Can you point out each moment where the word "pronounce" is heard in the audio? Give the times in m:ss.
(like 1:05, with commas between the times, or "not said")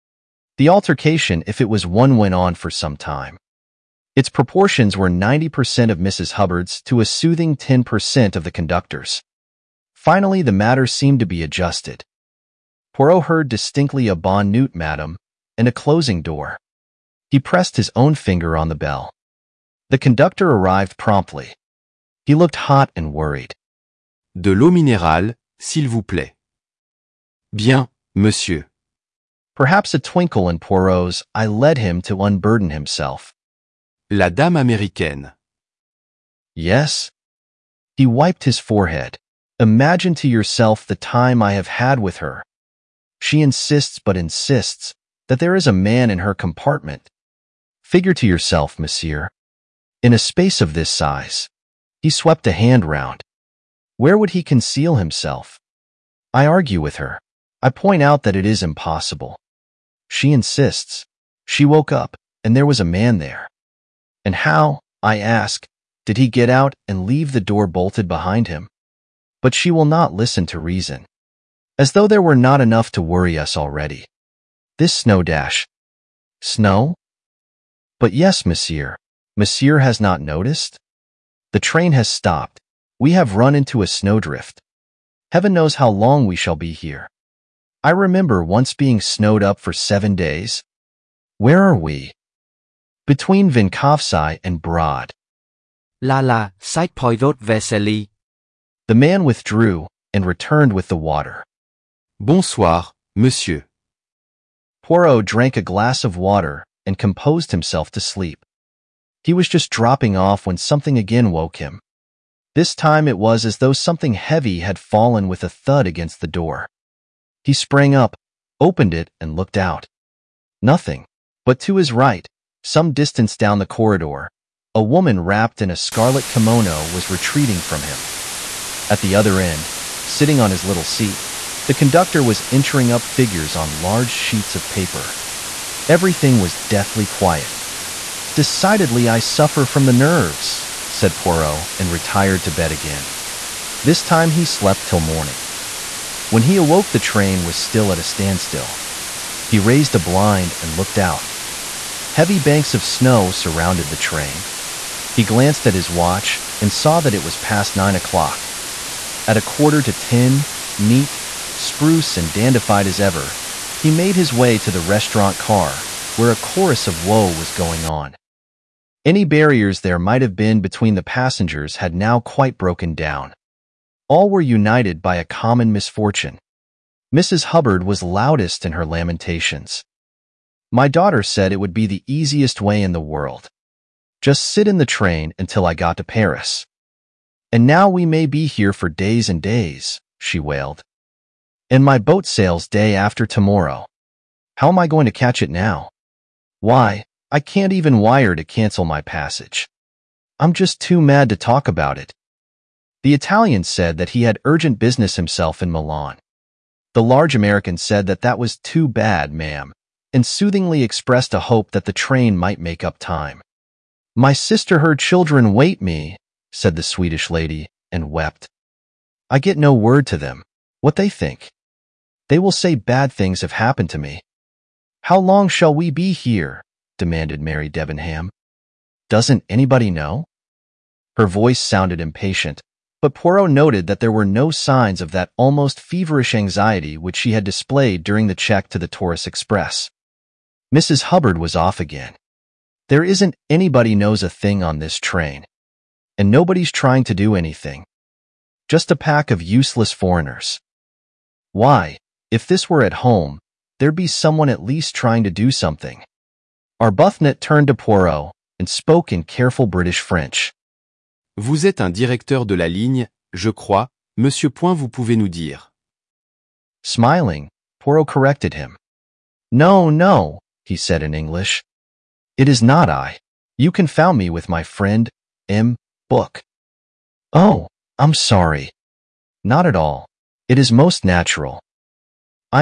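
not said.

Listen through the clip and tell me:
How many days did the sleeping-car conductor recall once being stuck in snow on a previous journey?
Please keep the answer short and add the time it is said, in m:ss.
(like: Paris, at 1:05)
7, at 1:29.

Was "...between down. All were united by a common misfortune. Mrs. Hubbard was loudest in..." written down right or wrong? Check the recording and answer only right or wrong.
wrong.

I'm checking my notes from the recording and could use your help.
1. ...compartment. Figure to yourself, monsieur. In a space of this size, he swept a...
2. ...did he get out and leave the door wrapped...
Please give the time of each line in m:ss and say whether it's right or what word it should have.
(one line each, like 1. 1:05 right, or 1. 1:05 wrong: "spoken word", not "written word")
1. 0:46 right
2. 1:06 wrong: "bolted", not "wrapped".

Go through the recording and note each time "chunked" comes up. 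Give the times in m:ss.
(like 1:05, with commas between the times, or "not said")
not said.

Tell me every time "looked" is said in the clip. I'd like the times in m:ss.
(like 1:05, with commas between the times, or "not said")
0:22, 1:59, 2:30.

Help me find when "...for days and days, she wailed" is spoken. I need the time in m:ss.
3:08.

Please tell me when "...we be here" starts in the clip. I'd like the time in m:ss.
3:45.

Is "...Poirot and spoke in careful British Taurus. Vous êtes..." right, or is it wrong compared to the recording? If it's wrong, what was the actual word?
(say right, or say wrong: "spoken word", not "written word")
wrong: "French", not "Taurus".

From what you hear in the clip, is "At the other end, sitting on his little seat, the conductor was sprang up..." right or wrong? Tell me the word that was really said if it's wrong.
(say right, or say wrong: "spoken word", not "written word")
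wrong: "entering", not "sprang".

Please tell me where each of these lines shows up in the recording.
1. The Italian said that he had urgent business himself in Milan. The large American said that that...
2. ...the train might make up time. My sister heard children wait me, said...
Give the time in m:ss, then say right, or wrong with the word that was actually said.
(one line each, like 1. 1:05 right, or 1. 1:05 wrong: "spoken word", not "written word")
1. 3:23 right
2. 3:31 right.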